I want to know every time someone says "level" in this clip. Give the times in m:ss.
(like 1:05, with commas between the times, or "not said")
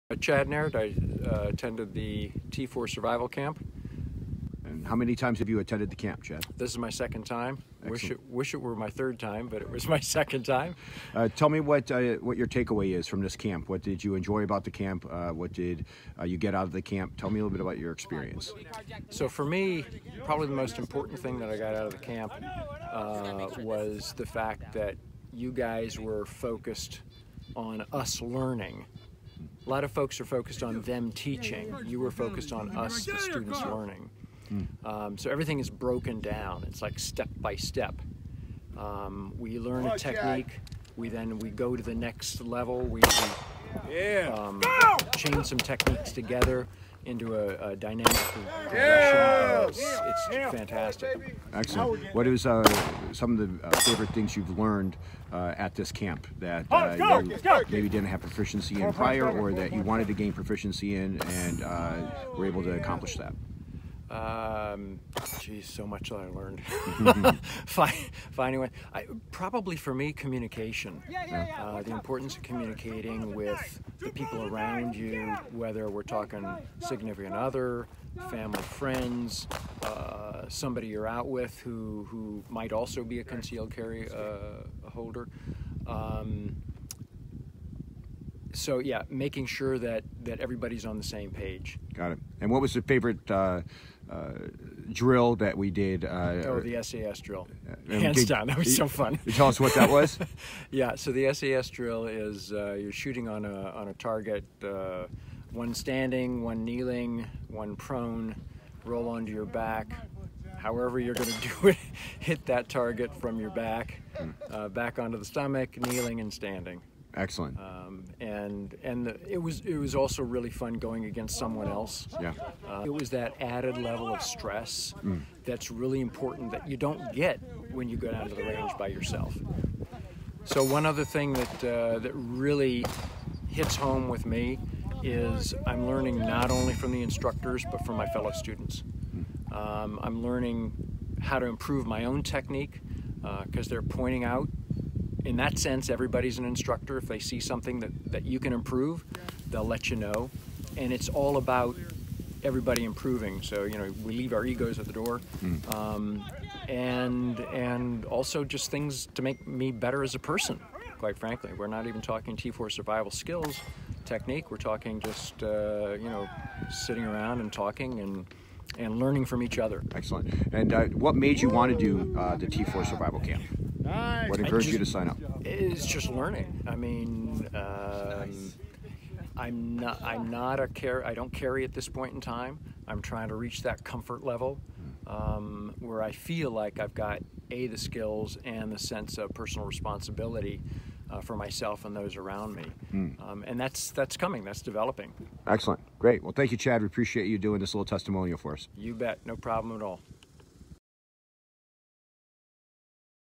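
0:42, 2:03, 3:04.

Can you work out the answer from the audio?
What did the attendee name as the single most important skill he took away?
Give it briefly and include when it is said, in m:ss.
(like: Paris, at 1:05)
Communication, at 1:10.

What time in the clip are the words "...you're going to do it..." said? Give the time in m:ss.
1:50.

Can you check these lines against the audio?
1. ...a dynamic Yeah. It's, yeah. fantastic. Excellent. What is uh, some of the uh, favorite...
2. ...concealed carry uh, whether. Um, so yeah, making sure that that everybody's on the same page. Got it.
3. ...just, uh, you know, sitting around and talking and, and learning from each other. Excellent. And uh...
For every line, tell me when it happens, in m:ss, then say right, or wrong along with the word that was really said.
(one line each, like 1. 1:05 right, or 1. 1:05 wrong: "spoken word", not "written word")
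1. 0:47 right
2. 1:23 wrong: "holder", not "whether"
3. 2:44 right.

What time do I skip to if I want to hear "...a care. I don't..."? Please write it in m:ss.
3:00.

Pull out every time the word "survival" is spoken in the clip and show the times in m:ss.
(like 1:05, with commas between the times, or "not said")
0:02, 2:42, 2:52.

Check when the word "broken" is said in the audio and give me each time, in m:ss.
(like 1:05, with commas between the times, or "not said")
0:35.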